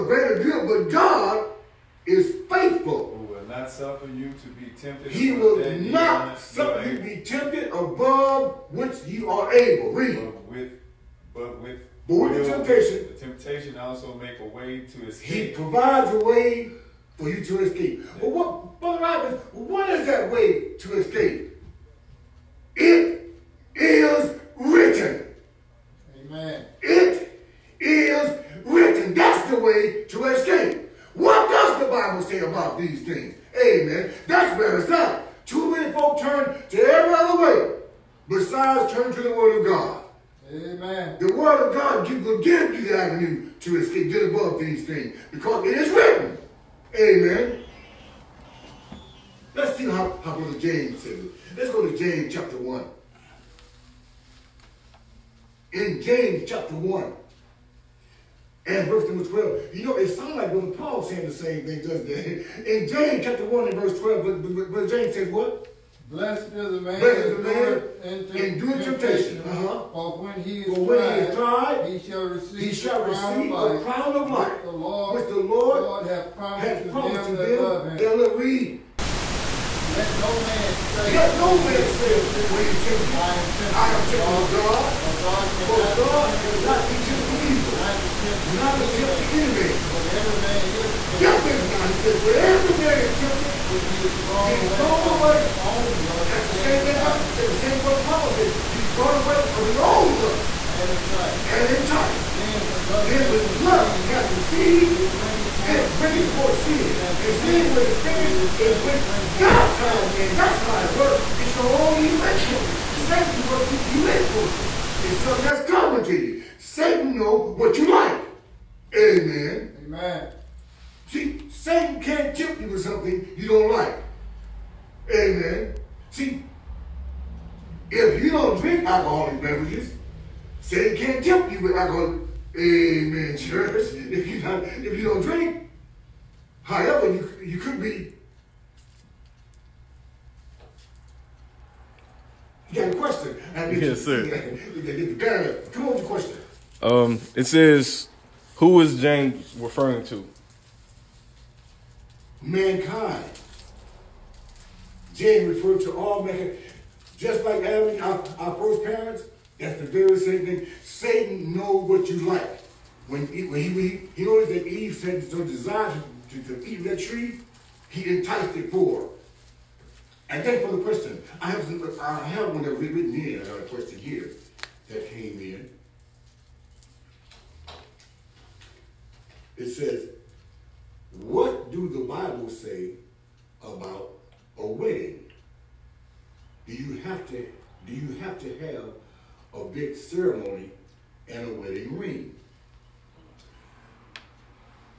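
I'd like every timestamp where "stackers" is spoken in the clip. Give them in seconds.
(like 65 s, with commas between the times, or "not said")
not said.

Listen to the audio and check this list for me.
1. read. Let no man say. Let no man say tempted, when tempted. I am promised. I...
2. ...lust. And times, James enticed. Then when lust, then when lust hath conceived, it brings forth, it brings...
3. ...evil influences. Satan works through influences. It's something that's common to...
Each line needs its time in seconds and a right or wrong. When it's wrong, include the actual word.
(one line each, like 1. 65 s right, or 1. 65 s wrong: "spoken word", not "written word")
1. 78 s wrong: "tempted", not "promised"
2. 100 s wrong: "And", not "James"
3. 112 s right.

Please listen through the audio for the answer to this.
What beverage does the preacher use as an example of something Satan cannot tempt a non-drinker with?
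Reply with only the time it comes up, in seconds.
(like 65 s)
131 s.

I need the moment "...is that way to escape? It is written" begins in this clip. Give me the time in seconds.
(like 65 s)
19 s.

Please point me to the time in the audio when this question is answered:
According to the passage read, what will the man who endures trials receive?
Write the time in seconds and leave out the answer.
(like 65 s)
73 s.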